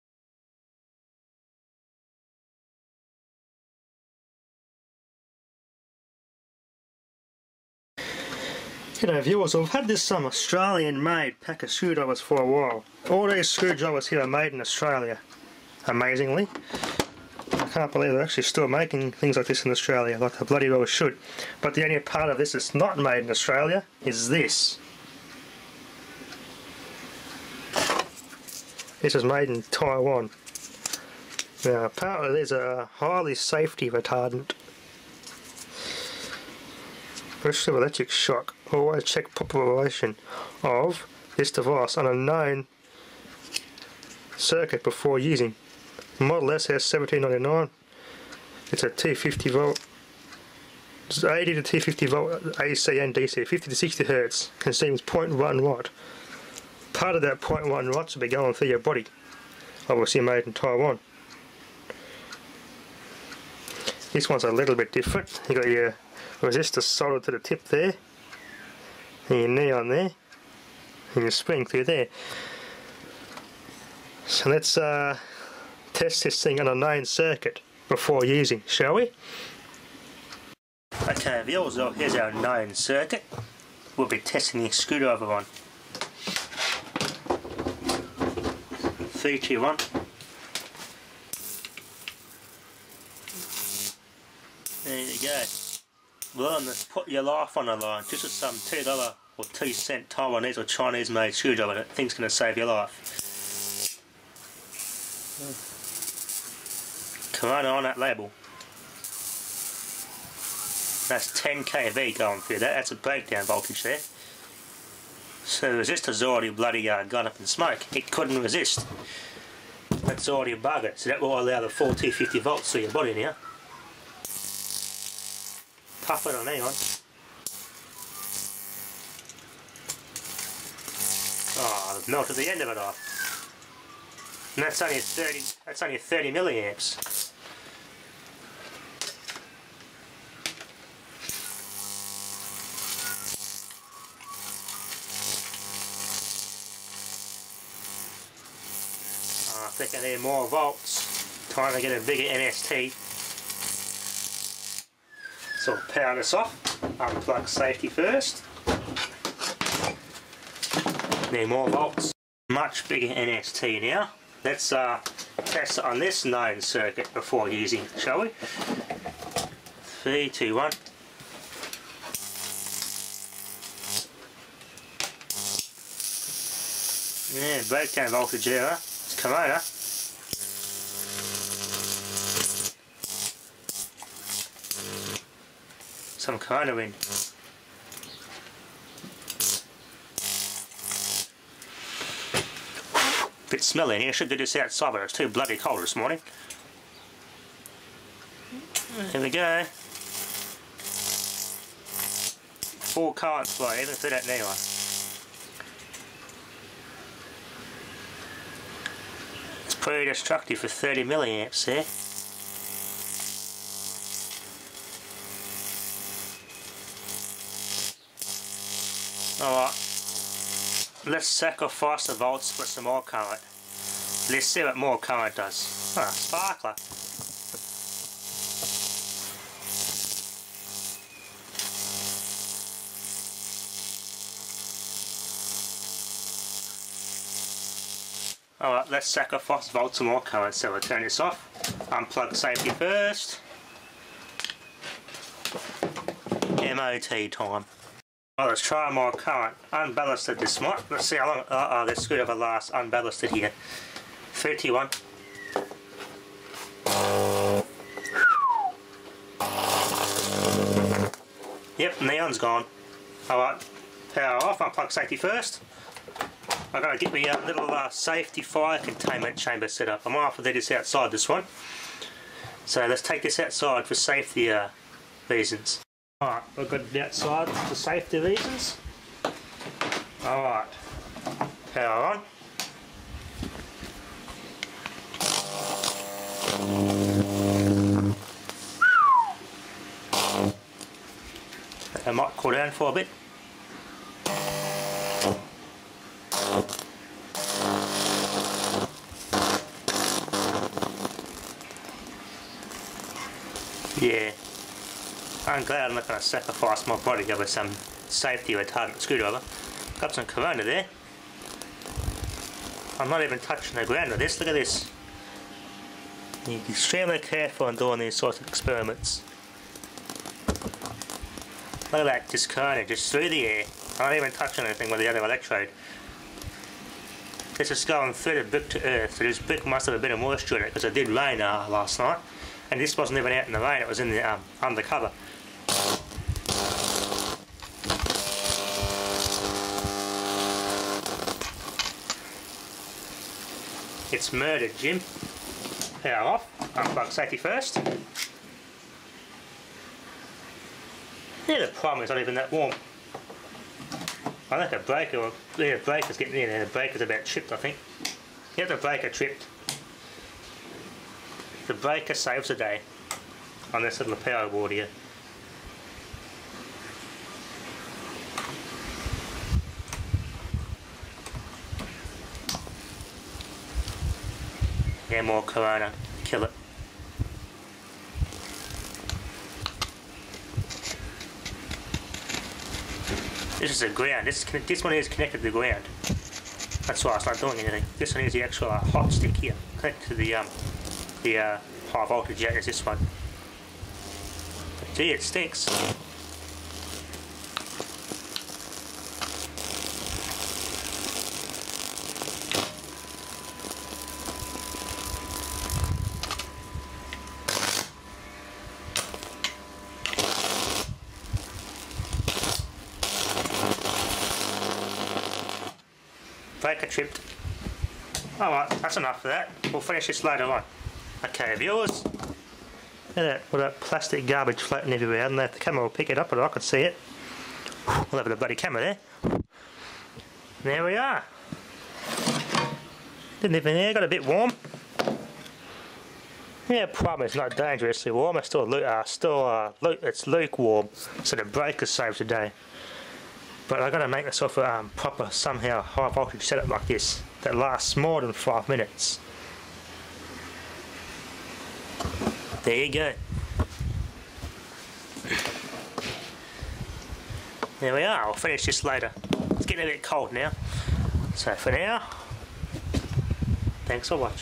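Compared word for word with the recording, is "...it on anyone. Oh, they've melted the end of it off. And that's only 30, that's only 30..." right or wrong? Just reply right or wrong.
right.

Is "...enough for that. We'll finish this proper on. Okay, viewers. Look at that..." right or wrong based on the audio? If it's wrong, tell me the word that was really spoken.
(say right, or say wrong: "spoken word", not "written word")
wrong: "later", not "proper".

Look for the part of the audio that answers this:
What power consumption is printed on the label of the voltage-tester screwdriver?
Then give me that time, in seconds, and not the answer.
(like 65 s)
55 s.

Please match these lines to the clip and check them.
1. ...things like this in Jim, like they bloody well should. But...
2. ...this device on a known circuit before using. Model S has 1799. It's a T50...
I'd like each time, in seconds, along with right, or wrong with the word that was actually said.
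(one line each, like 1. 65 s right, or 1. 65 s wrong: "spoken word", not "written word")
1. 19 s wrong: "Australia", not "Jim"
2. 41 s right.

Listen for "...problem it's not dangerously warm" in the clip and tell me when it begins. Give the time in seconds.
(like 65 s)
436 s.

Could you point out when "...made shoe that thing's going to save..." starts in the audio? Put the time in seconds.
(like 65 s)
101 s.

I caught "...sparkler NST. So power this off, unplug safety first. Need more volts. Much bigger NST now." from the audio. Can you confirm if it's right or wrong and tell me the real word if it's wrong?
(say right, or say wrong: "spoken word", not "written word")
wrong: "bigger", not "sparkler".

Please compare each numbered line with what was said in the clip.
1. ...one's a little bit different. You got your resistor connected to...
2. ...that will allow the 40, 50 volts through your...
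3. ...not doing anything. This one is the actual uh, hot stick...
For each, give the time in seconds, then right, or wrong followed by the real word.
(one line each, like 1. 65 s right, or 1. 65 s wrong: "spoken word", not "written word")
1. 64 s wrong: "soldered", not "connected"
2. 121 s right
3. 387 s right.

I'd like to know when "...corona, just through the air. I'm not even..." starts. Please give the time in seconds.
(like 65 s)
322 s.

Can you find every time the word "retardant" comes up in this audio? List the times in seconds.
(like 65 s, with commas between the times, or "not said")
33 s, 308 s.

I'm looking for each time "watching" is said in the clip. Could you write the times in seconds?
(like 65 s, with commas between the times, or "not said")
464 s.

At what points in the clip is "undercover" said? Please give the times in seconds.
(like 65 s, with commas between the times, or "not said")
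334 s.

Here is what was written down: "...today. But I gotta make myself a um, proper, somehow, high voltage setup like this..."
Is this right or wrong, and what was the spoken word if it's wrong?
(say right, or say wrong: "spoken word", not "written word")
right.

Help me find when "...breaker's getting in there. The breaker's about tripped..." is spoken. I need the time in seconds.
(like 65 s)
355 s.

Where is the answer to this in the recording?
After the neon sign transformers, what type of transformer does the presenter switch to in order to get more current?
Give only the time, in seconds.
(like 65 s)
246 s.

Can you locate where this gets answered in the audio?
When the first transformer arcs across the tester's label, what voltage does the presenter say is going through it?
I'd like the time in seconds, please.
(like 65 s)
111 s.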